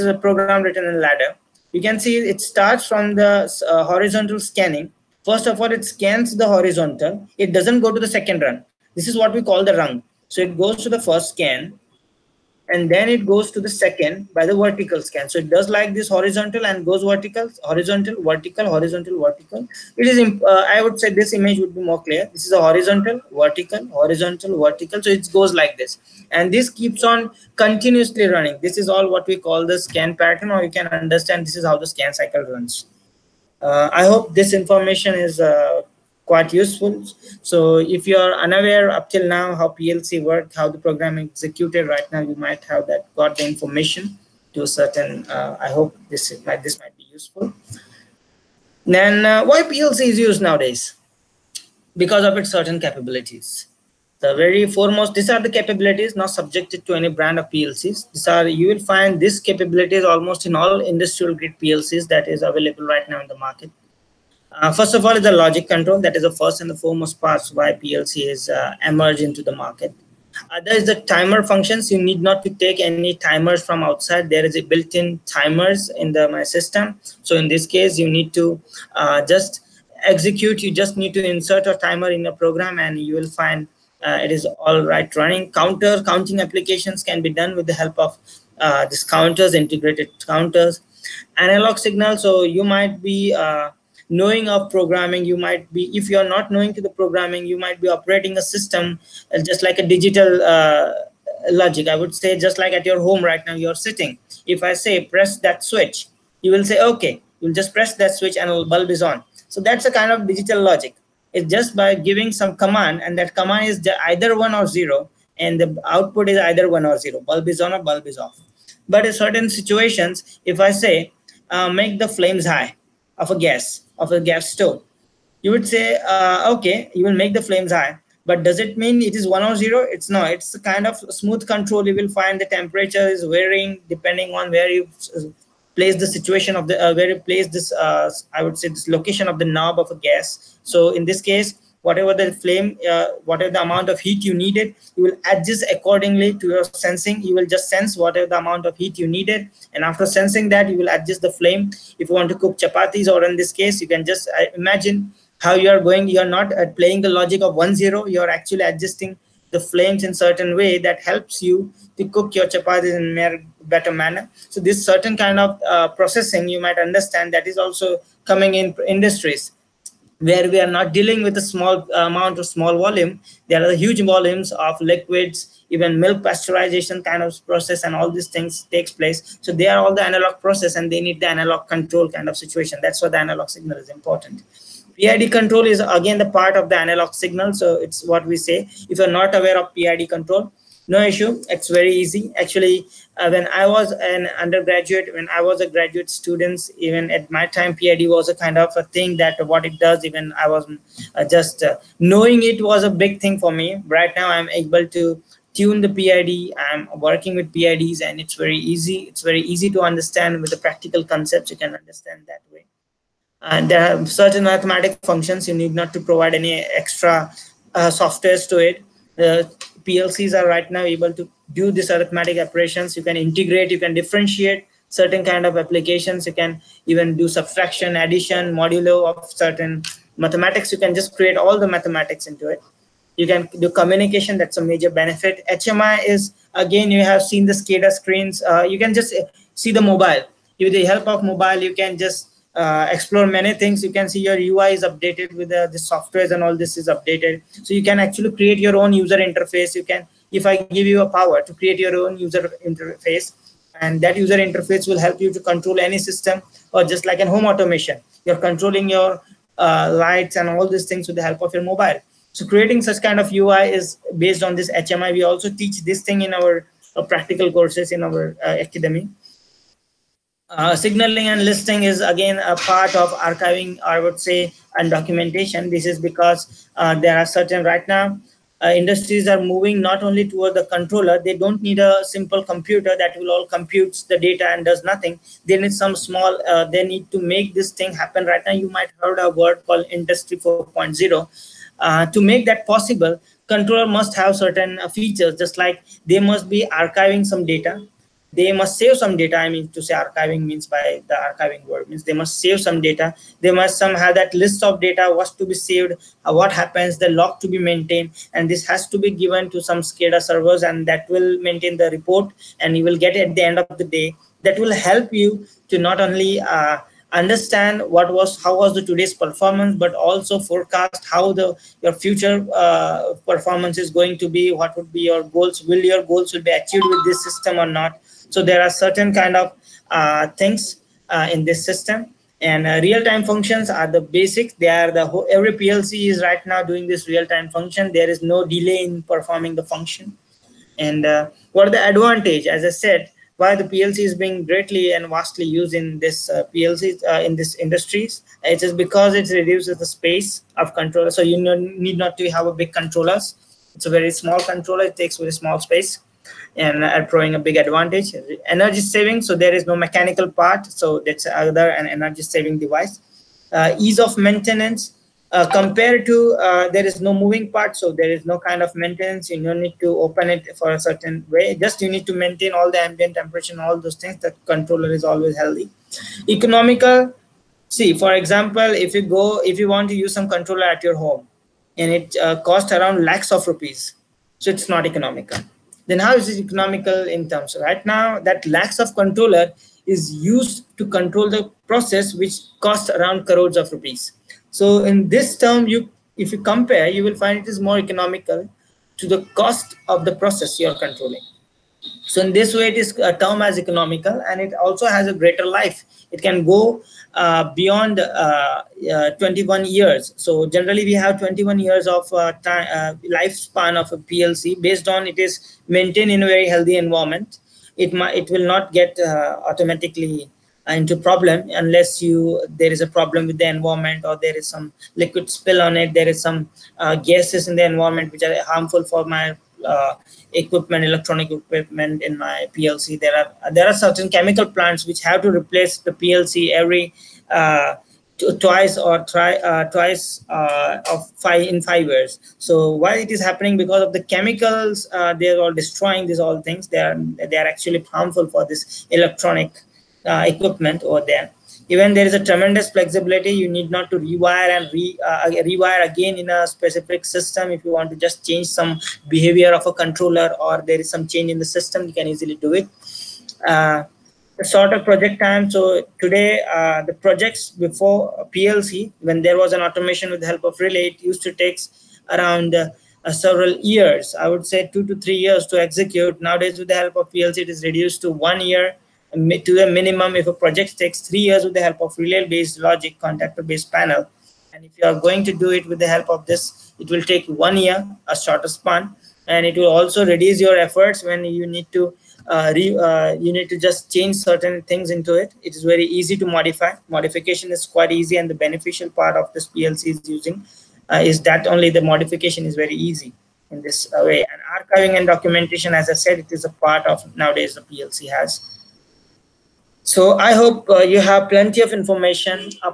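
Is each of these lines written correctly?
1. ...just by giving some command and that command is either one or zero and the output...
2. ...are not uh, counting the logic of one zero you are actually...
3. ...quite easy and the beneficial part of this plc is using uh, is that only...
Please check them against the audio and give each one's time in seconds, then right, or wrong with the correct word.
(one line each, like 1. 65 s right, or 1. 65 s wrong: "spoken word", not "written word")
1. 111 s right
2. 156 s wrong: "playing", not "counting"
3. 497 s right.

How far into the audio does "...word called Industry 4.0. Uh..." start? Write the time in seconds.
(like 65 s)
289 s.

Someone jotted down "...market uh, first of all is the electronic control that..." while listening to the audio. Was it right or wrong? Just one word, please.
wrong.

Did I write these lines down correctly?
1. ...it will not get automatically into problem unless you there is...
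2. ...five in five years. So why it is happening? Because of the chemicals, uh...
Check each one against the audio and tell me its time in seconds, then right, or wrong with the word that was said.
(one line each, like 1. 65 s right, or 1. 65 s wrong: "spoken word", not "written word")
1. 418 s right
2. 441 s right.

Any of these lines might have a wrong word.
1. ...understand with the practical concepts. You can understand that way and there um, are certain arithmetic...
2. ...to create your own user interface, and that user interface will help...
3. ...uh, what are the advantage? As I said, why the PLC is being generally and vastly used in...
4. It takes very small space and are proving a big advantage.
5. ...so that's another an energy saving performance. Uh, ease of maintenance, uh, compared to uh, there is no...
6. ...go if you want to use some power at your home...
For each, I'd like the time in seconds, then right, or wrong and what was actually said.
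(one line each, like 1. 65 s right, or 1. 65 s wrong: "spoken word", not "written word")
1. 209 s right
2. 251 s right
3. 341 s wrong: "greatly", not "generally"
4. 354 s right
5. 360 s wrong: "device", not "performance"
6. 379 s wrong: "controller", not "power".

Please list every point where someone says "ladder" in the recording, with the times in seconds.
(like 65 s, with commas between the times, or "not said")
1 s.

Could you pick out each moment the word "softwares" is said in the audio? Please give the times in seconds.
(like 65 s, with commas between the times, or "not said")
217 s, 245 s.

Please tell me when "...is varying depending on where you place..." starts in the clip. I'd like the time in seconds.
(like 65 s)
133 s.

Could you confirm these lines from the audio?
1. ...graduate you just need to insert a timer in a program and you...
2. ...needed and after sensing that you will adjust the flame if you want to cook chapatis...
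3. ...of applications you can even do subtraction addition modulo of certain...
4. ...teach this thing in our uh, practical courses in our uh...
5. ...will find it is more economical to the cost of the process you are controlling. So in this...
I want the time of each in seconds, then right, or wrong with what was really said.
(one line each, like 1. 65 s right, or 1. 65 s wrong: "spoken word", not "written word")
1. 80 s wrong: "execute", not "graduate"
2. 149 s right
3. 225 s right
4. 265 s right
5. 397 s right.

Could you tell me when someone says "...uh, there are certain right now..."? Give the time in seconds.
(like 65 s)
276 s.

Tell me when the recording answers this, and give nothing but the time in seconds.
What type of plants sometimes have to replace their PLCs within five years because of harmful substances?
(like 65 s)
434 s.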